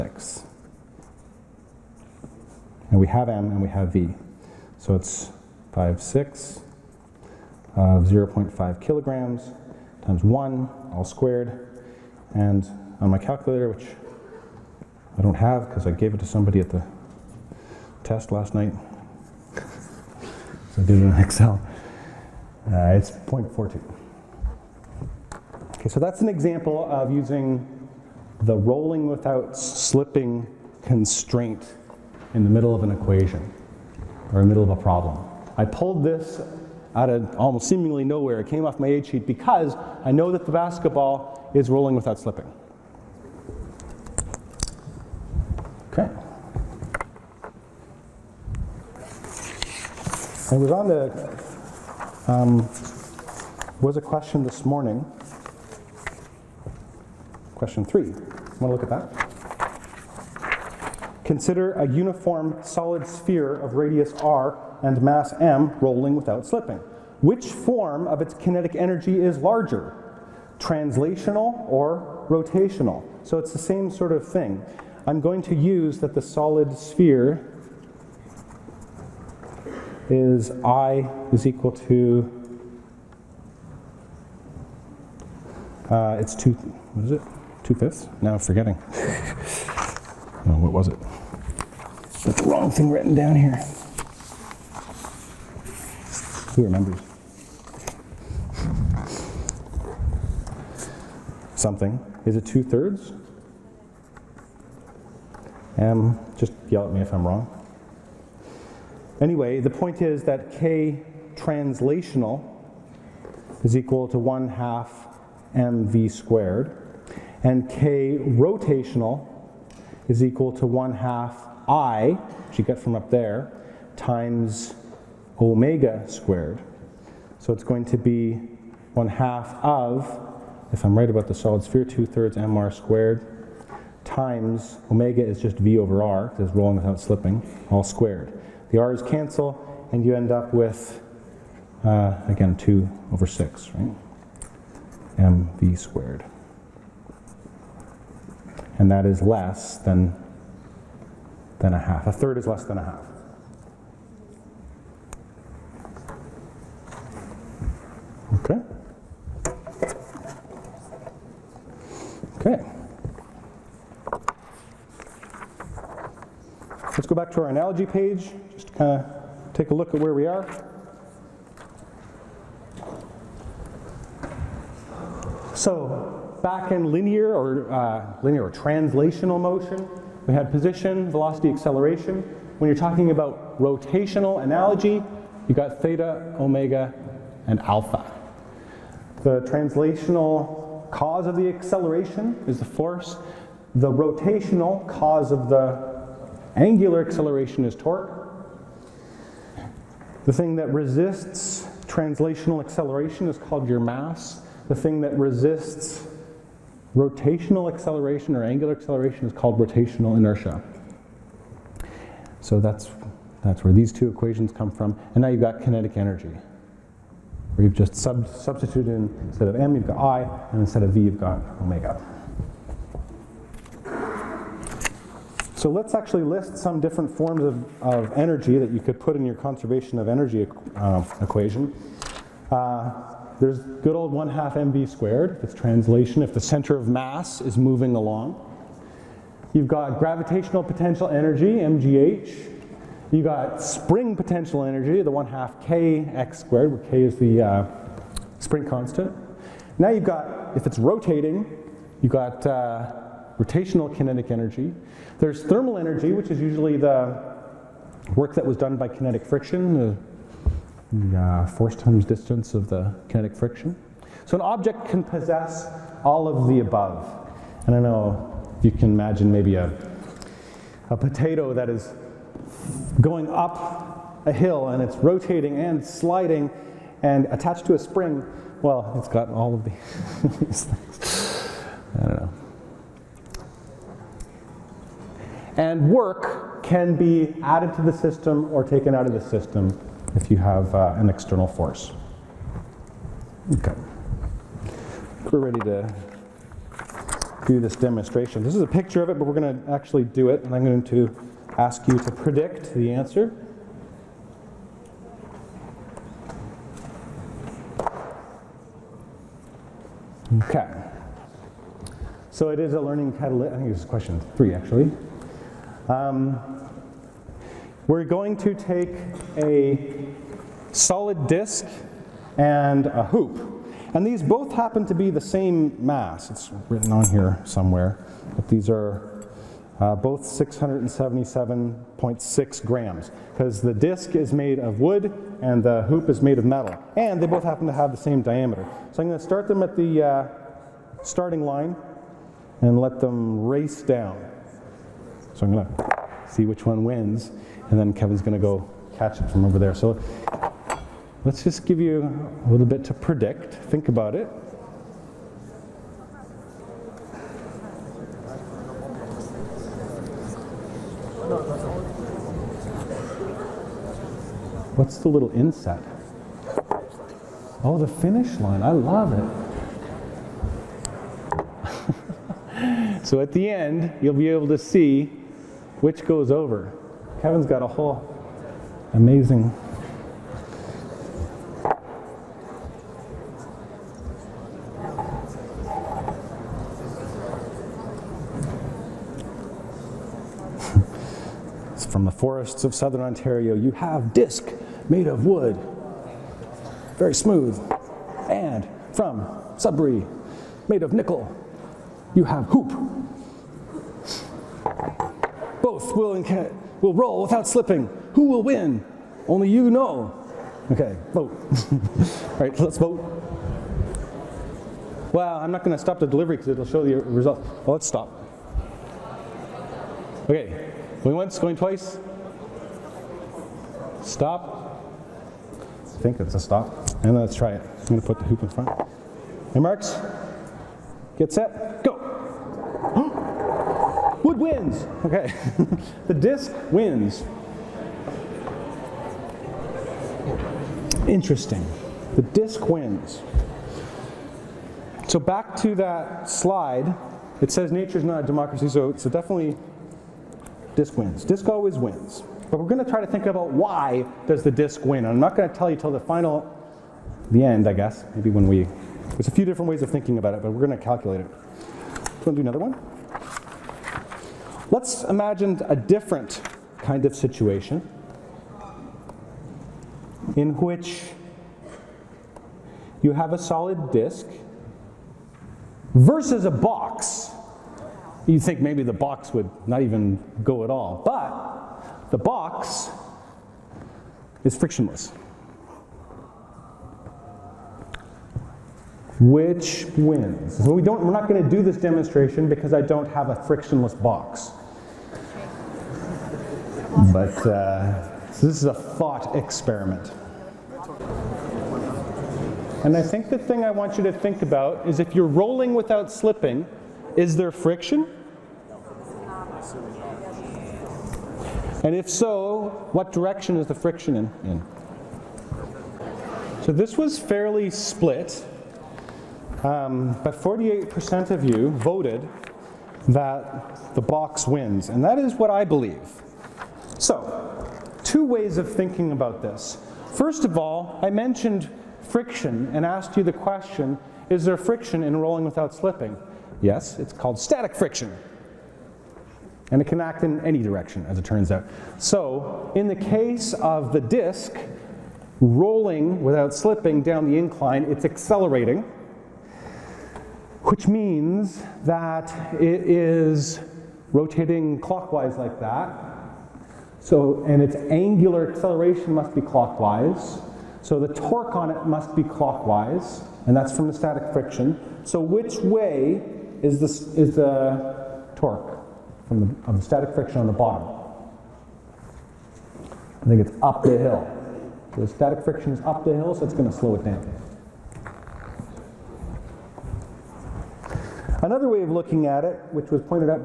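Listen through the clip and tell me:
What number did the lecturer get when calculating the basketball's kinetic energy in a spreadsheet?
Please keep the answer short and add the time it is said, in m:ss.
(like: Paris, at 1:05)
0.42, at 0:23.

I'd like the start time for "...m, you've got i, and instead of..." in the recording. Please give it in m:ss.
3:39.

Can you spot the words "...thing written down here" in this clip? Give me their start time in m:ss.
1:32.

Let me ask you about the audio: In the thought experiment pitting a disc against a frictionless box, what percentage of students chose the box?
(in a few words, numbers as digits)
48%.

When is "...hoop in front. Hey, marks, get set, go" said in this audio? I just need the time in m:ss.
7:08.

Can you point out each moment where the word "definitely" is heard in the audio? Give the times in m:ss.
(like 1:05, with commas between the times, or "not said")
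7:29.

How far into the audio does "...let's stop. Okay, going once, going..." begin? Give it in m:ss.
6:57.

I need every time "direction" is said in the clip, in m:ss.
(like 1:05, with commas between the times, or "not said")
8:33, 9:00.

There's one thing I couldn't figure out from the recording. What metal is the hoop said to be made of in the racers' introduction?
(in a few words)
nickel.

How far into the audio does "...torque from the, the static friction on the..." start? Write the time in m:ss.
9:28.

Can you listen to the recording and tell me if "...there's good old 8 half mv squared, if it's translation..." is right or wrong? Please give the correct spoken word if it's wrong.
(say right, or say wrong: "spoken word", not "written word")
wrong: "1", not "8".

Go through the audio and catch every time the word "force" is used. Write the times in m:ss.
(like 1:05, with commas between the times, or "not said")
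3:12, 4:21, 4:51.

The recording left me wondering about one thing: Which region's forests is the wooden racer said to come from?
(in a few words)
southern Ontario.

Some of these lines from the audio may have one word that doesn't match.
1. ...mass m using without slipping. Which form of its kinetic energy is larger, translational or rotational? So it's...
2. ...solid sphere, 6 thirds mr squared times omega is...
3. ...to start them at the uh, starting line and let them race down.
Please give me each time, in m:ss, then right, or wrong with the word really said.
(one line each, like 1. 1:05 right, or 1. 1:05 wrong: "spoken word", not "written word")
1. 1:05 wrong: "rolling", not "using"
2. 2:11 wrong: "2", not "6"
3. 5:39 right.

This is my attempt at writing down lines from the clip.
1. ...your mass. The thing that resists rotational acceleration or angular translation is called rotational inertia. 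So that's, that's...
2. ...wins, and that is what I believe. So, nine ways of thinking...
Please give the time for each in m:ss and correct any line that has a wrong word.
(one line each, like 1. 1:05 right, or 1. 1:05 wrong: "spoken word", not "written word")
1. 3:23 wrong: "acceleration", not "translation"
2. 8:44 wrong: "two", not "nine".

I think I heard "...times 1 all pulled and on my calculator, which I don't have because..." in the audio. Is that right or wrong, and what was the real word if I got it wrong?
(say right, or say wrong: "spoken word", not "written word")
wrong: "squared", not "pulled".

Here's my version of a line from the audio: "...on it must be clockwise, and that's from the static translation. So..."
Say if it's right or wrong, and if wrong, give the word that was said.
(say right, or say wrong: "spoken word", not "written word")
wrong: "friction", not "translation".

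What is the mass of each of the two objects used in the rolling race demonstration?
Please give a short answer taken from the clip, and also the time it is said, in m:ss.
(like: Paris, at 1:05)
677.6 grams, at 5:30.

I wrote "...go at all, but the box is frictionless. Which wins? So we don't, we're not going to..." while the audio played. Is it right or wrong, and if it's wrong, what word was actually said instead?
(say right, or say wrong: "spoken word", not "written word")
right.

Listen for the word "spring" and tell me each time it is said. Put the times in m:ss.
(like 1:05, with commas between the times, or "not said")
4:03, 4:08, 4:37.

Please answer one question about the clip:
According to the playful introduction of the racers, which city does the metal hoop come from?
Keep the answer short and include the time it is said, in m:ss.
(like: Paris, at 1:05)
Sudbury, at 6:39.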